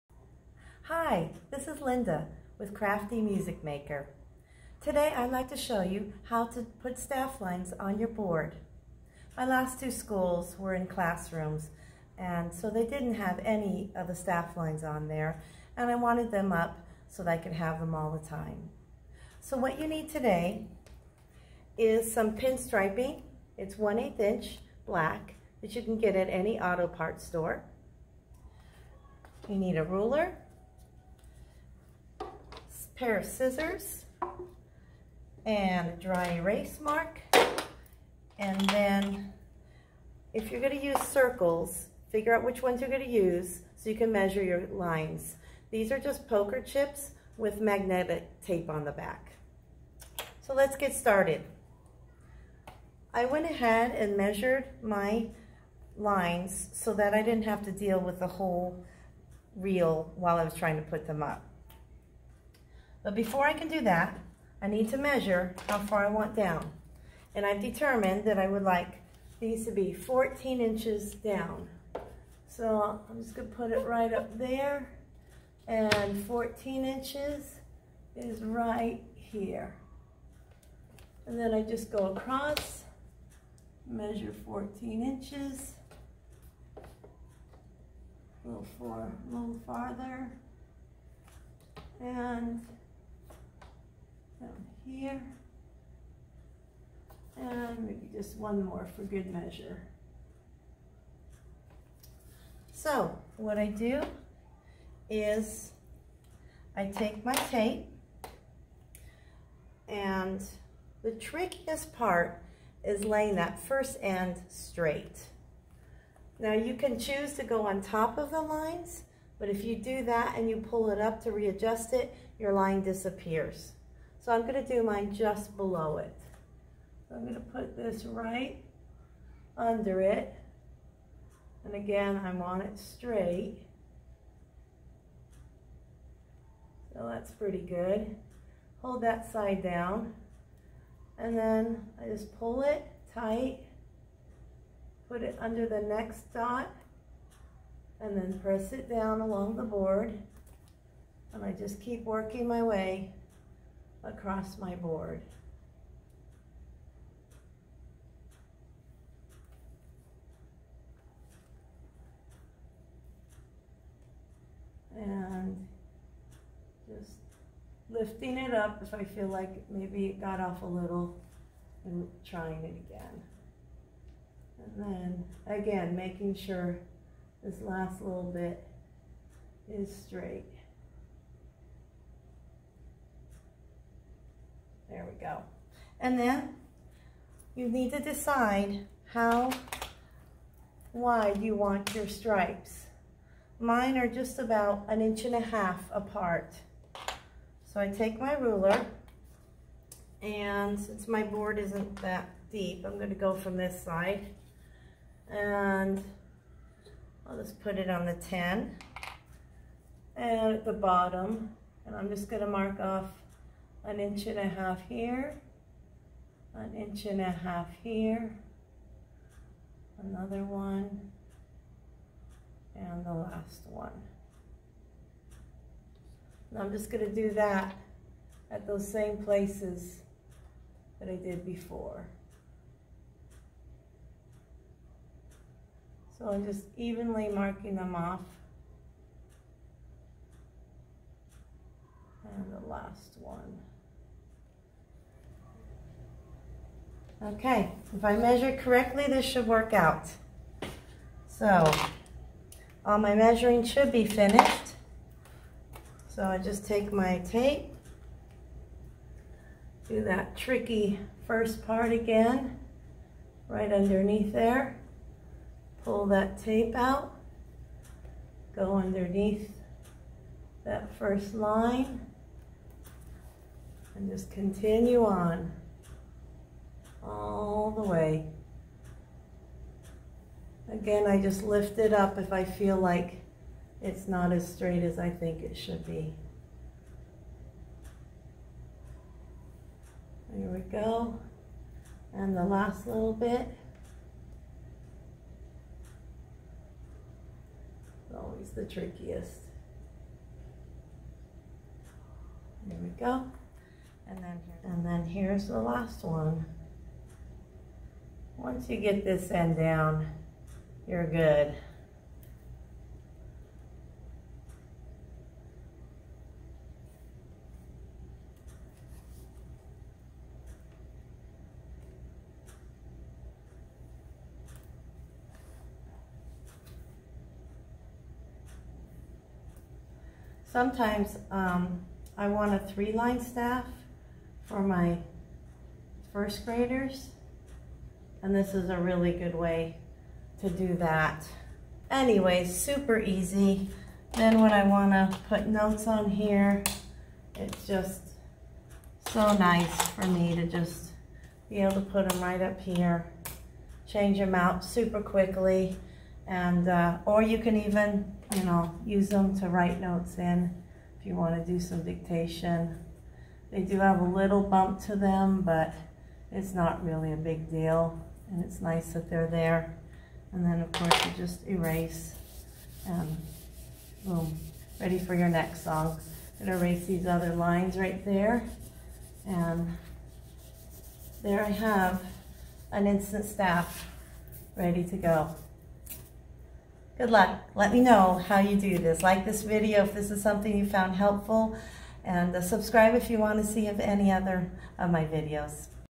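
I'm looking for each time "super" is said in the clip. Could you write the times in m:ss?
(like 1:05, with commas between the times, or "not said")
5:42, 5:54.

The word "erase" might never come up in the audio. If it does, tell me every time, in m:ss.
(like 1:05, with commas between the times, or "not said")
0:36, 6:11, 6:16.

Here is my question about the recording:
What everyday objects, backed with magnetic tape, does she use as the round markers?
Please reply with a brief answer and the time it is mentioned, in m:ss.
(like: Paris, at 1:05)
poker chips, at 0:46.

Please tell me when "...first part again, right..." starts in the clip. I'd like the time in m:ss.
4:21.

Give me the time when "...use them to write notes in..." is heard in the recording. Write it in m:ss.
5:58.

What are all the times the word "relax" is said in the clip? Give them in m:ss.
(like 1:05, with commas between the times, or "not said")
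not said.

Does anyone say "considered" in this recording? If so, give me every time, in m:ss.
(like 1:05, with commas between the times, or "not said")
not said.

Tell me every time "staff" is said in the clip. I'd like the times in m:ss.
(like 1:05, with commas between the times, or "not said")
0:06, 0:14, 5:33, 6:23.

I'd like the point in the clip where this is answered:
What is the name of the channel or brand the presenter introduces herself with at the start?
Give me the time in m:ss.
0:02.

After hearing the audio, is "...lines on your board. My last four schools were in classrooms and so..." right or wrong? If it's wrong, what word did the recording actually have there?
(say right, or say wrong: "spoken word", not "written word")
wrong: "two", not "four".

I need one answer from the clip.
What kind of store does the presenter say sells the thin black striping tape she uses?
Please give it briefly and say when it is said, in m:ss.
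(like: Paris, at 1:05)
auto parts store, at 0:26.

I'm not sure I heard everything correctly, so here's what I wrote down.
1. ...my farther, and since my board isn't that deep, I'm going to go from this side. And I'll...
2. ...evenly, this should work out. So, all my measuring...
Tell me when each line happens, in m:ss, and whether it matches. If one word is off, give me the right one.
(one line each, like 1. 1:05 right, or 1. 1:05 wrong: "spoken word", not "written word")
1. 3:18 wrong: "ruler", not "farther"
2. 4:08 wrong: "correctly", not "evenly".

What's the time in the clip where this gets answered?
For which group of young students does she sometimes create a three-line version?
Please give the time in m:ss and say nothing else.
5:36.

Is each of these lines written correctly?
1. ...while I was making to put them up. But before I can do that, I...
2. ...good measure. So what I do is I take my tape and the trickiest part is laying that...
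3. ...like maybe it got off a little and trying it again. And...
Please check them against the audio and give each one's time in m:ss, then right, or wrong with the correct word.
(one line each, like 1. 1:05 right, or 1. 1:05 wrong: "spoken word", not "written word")
1. 1:00 wrong: "trying", not "making"
2. 1:39 right
3. 2:49 right.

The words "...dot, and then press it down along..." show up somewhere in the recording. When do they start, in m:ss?
2:26.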